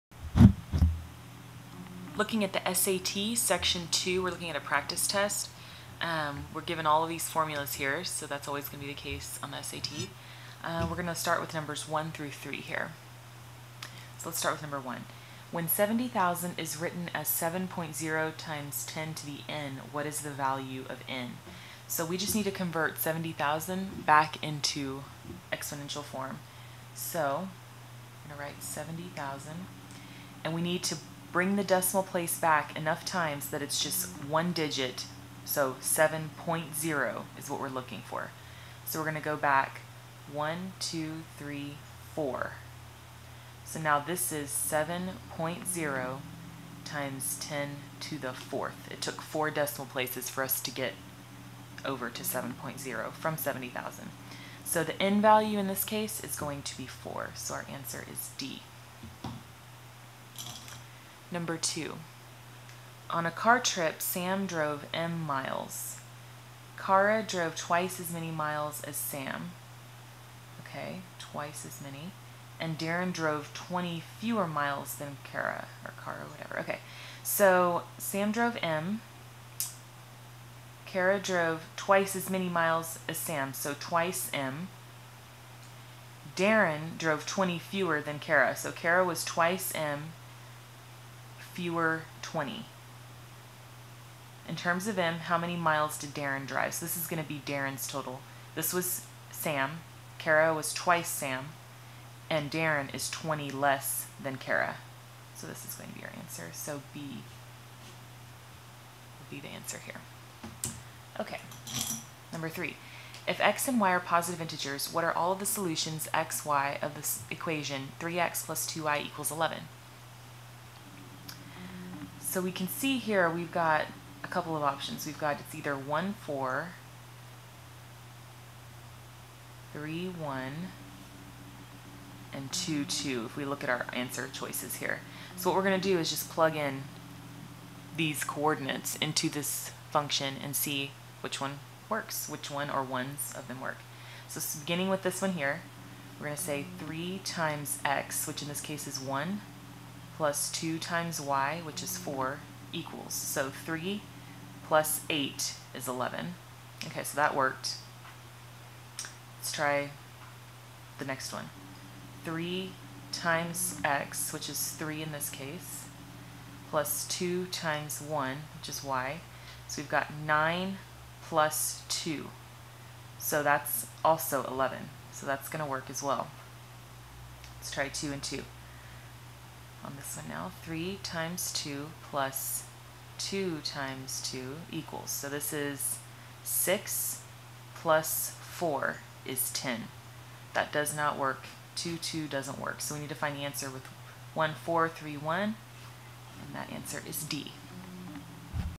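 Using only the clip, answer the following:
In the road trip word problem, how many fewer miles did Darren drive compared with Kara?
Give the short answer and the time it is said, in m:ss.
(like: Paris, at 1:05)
20, at 1:12.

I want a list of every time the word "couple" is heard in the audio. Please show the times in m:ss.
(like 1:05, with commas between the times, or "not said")
2:04.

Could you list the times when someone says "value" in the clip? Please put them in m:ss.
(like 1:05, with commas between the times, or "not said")
0:20, 0:55.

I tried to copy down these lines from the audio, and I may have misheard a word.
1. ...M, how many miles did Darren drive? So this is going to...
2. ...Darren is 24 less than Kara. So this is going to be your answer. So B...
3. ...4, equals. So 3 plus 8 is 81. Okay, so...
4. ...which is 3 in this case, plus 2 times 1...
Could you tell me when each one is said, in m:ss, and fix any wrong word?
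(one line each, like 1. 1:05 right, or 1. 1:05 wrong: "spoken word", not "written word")
1. 1:34 right
2. 1:42 wrong: "20", not "24"
3. 2:31 wrong: "11", not "81"
4. 2:44 right.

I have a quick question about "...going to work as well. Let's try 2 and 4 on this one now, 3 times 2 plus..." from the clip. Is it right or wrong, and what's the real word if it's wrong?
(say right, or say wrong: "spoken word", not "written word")
wrong: "2", not "4".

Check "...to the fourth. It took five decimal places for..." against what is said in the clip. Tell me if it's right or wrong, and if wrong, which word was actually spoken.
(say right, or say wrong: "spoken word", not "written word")
wrong: "four", not "five".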